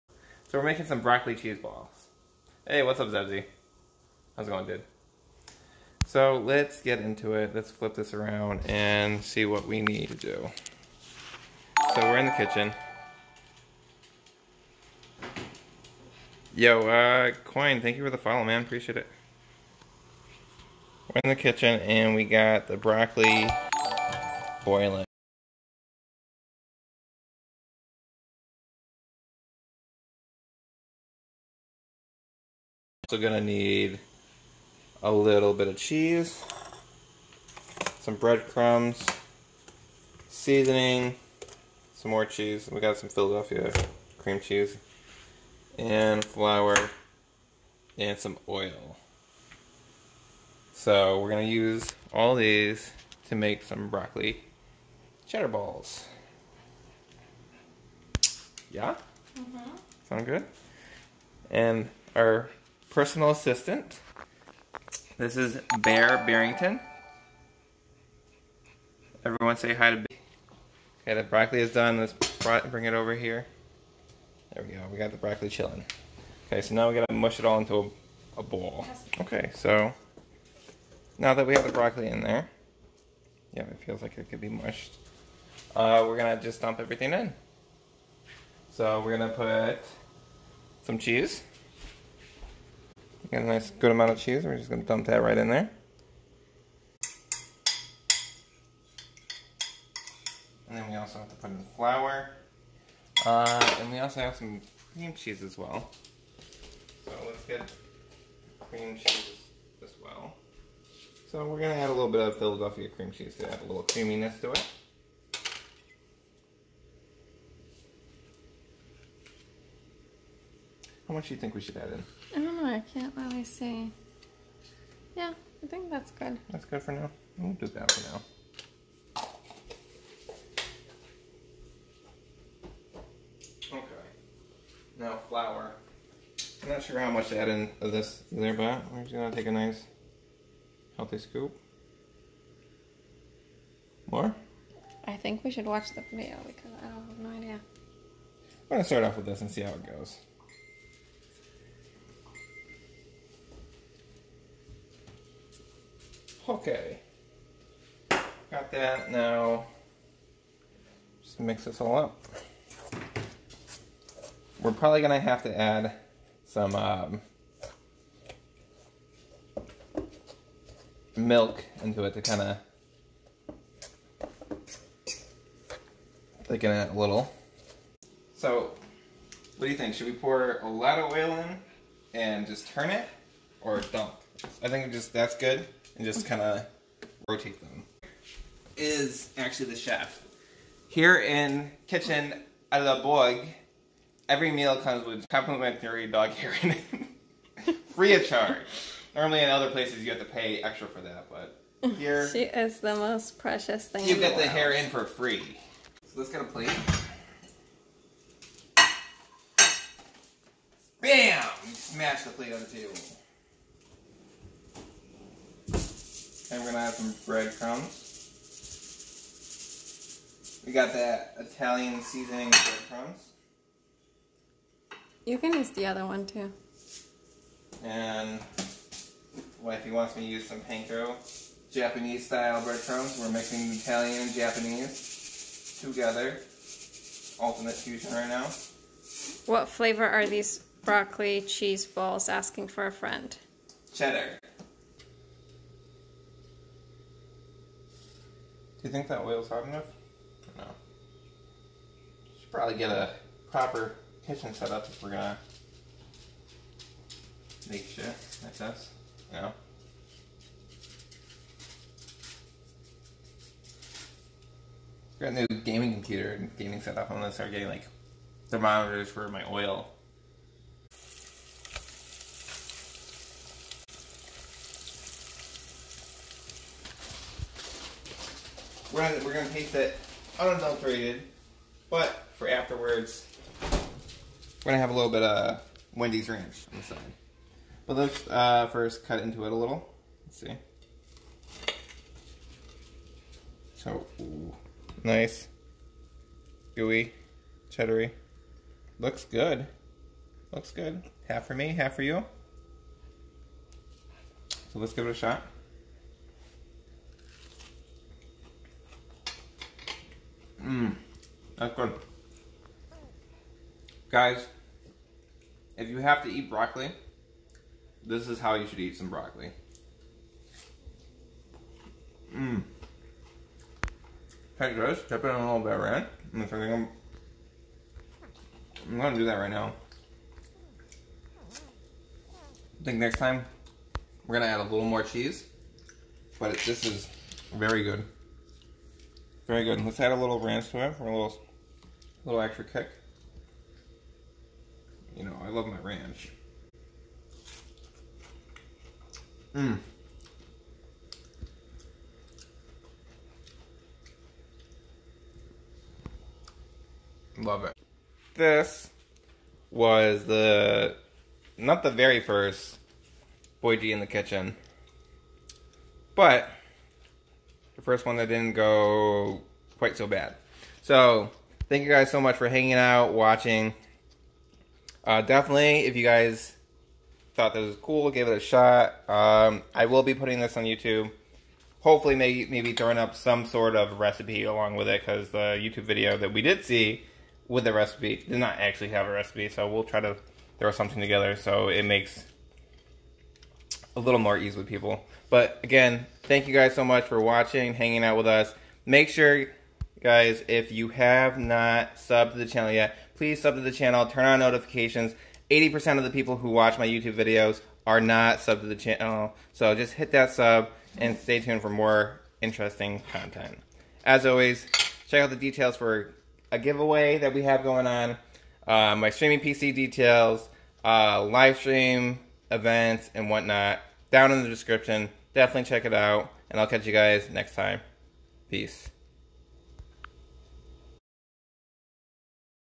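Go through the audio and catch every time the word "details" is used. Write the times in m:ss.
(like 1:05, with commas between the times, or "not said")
6:55, 6:59.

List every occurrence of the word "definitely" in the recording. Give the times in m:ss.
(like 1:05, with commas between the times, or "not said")
6:15, 7:05.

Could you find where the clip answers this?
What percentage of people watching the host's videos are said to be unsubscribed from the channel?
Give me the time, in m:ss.
6:45.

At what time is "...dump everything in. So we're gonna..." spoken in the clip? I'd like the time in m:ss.
1:26.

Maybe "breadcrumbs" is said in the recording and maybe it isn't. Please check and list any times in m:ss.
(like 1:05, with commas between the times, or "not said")
0:38, 3:37, 3:42, 3:52.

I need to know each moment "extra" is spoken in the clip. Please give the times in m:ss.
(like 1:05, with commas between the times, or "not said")
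3:20, 5:42.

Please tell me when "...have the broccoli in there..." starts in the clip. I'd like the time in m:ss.
1:21.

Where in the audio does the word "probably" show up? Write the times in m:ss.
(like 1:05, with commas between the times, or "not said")
2:44, 4:12.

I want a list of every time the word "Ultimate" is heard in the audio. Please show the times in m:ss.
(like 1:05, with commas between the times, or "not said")
3:57.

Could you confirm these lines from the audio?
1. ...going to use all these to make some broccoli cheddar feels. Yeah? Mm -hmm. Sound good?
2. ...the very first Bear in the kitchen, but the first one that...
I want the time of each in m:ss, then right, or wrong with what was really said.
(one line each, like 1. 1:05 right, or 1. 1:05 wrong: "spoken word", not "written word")
1. 0:51 wrong: "balls", not "feels"
2. 6:01 wrong: "Boyg", not "Bear".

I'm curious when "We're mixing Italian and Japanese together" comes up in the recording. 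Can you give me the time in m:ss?
3:53.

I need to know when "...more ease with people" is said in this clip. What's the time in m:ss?
6:34.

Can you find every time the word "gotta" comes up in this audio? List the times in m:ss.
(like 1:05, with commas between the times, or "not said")
1:16.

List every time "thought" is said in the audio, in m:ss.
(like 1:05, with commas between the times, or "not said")
6:17.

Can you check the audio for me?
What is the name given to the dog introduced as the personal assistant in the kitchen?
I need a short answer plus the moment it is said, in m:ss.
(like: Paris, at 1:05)
Bear Barrington, at 1:05.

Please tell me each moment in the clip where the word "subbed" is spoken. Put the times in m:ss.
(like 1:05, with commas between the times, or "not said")
6:41, 6:48.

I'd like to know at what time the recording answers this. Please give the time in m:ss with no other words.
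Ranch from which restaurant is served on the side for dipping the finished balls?
4:45.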